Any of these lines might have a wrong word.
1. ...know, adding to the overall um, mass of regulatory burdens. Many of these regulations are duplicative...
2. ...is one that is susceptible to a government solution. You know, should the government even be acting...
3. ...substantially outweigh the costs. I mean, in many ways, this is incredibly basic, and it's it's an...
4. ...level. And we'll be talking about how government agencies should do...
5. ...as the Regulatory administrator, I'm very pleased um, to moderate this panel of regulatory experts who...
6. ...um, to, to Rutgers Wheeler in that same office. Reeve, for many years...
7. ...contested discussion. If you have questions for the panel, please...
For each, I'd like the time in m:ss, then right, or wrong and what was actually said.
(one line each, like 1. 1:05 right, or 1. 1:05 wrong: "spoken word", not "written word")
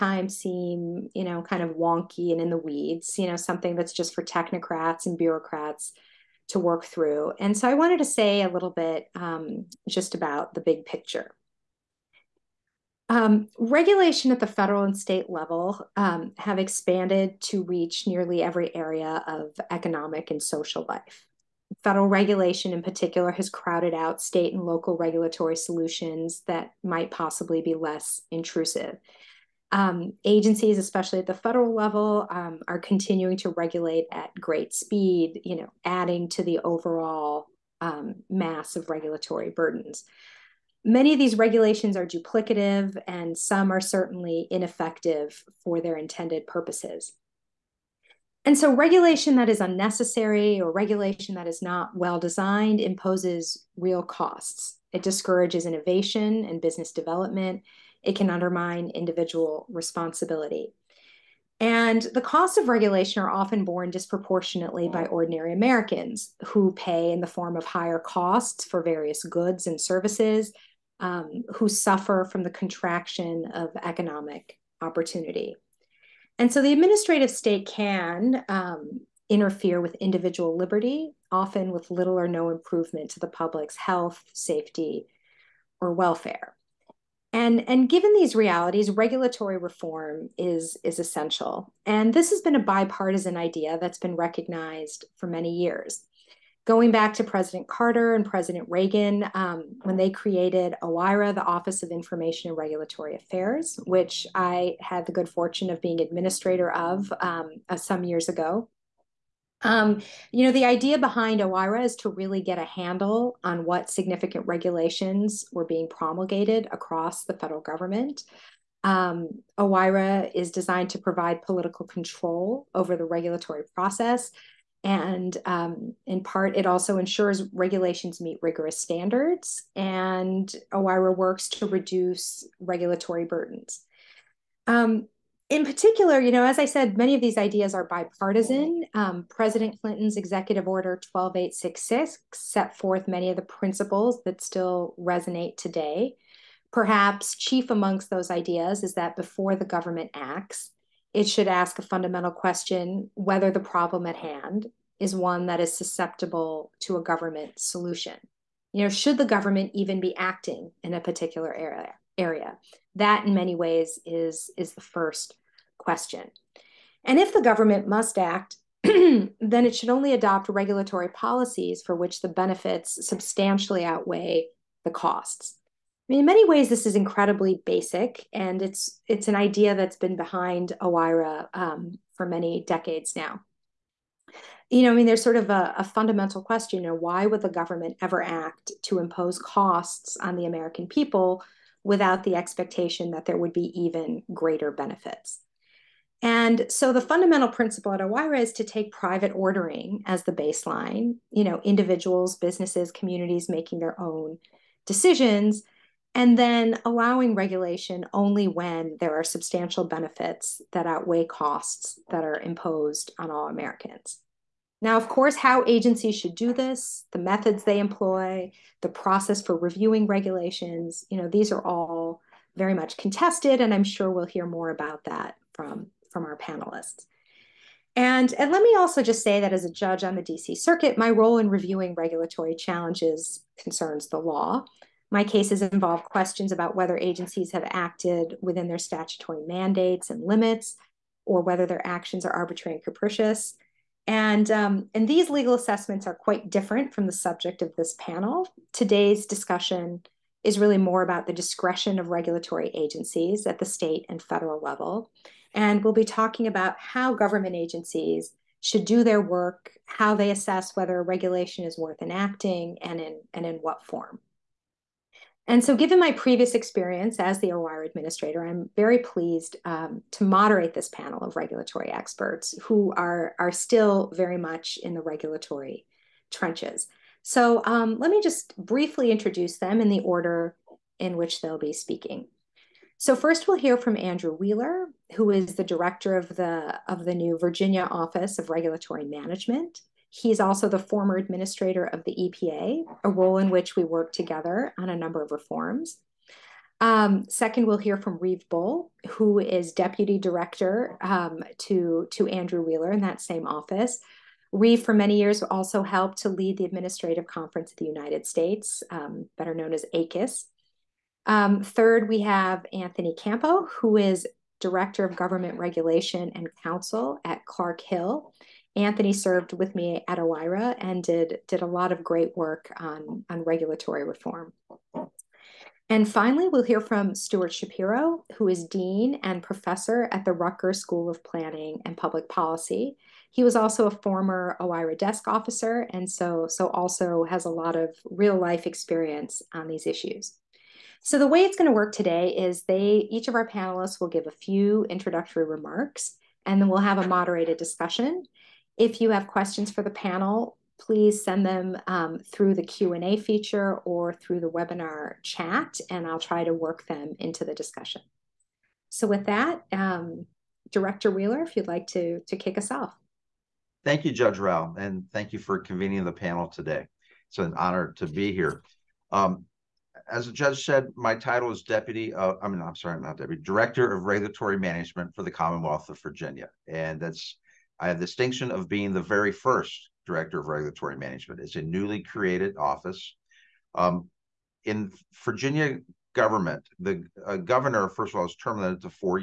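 1. 0:35 right
2. 2:34 right
3. 2:53 right
4. 4:14 right
5. 4:27 wrong: "OIRA", not "Regulatory"
6. 5:01 wrong: "Andrew", not "Rutgers"
7. 5:47 wrong: "moderated", not "contested".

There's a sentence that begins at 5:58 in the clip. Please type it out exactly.
So with that, um, Director Wheeler, if you'd like to, to kick us off.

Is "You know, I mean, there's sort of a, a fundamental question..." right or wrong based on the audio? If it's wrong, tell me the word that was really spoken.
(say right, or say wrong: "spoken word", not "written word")
right.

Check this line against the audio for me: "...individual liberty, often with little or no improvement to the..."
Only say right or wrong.
right.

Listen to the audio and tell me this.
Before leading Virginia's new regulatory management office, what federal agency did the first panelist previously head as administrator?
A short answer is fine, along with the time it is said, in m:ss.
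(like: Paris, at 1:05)
EPA, at 4:52.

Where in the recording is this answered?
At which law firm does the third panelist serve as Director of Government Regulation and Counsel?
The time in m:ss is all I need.
5:17.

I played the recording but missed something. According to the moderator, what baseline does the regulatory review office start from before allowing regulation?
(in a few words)
Private ordering.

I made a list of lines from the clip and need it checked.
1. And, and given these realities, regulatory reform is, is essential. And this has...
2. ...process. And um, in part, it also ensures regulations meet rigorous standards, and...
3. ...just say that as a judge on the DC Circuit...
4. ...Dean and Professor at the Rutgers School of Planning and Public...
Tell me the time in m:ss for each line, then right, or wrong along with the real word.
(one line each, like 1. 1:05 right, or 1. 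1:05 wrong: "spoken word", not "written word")
1. 1:27 right
2. 2:03 right
3. 3:49 right
4. 5:28 right.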